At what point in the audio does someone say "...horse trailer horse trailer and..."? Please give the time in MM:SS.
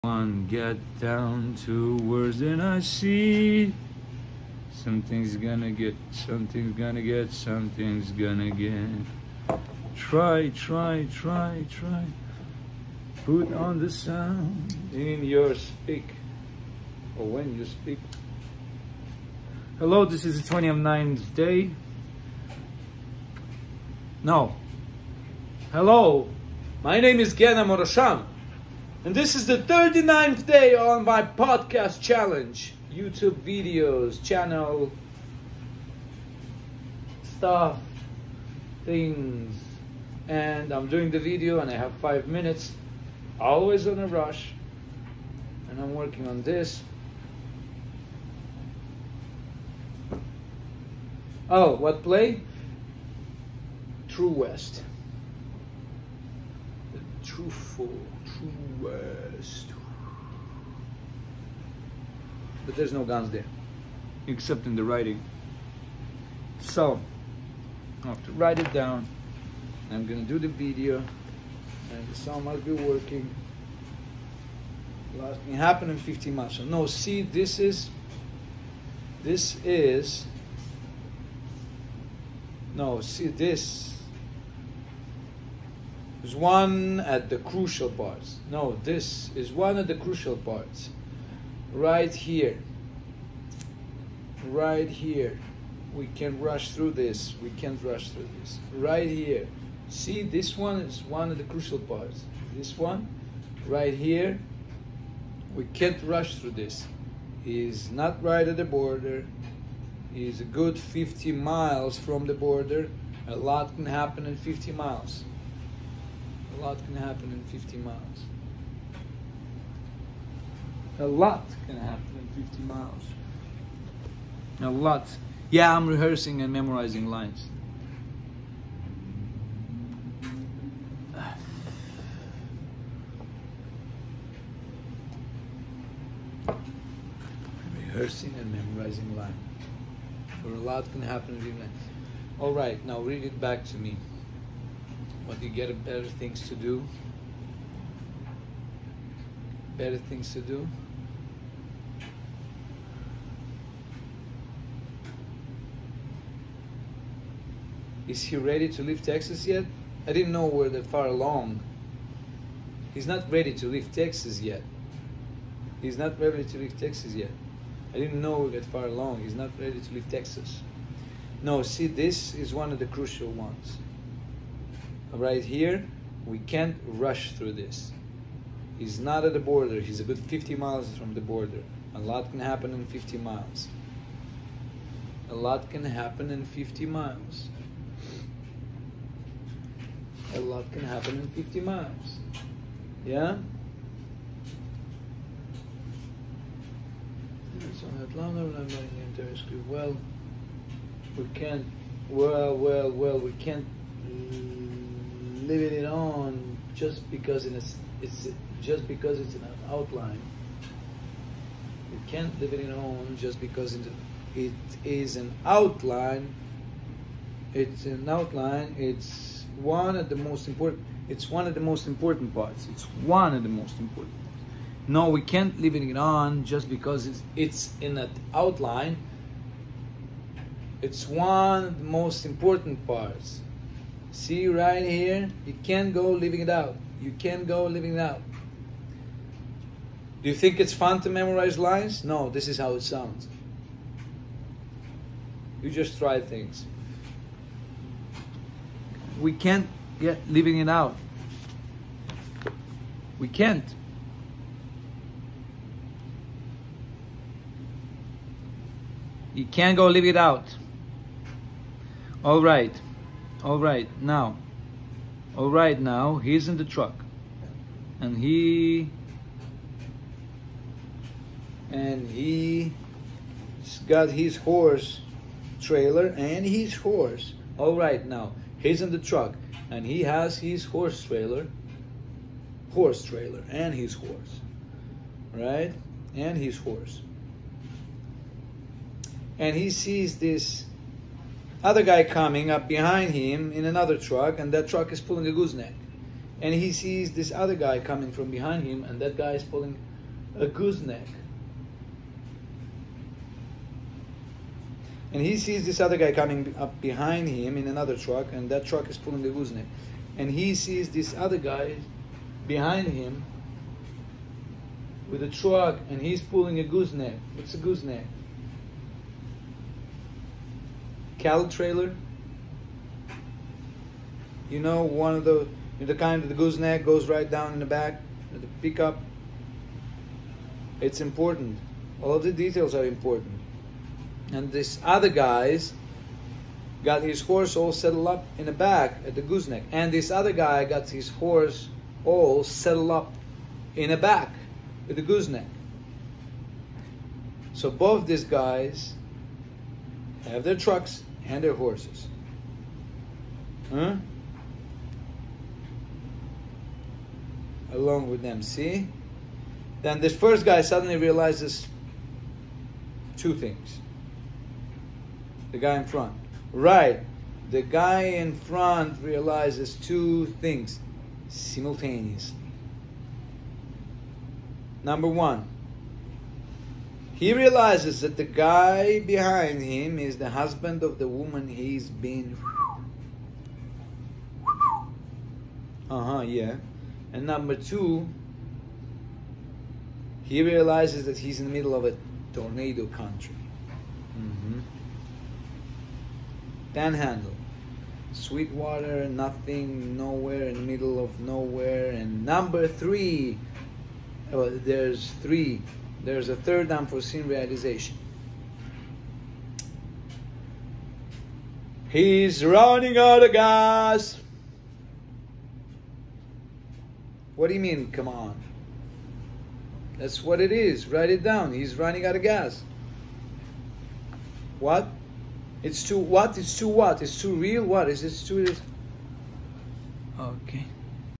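04:40.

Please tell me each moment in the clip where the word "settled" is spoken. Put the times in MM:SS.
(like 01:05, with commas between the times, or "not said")
05:37, 05:42.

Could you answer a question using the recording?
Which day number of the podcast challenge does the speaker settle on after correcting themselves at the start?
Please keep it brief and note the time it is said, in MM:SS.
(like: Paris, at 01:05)
39th, at 00:29.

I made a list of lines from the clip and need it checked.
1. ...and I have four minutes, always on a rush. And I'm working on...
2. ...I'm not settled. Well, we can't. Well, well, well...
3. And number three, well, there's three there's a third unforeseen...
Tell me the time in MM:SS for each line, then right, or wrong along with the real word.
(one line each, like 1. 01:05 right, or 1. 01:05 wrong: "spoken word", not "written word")
1. 00:41 wrong: "five", not "four"
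2. 03:18 wrong: "interested", not "settled"
3. 06:41 right.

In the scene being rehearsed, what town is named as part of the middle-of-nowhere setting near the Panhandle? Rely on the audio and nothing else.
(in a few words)
Sweetwater.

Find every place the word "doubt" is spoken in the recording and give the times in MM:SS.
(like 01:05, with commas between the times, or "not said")
not said.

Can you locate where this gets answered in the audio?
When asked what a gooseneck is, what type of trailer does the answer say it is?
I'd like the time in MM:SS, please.
05:21.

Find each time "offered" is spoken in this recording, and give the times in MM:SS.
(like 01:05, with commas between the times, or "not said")
not said.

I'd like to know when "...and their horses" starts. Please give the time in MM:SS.
05:51.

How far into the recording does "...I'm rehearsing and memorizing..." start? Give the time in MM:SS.
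02:05.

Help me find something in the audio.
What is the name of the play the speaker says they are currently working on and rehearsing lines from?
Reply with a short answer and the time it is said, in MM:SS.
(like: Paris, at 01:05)
True West, at 00:54.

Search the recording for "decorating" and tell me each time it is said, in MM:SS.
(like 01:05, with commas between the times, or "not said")
not said.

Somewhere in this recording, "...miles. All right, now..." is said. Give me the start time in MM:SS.
02:21.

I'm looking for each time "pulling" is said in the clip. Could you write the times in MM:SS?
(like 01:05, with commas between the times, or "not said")
04:54, 04:59, 05:08, 05:16.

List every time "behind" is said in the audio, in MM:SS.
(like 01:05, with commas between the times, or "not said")
04:52, 04:58, 05:06, 05:12, 06:18.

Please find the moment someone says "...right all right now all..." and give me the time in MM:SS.
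04:22.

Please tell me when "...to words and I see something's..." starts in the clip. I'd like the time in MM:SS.
00:01.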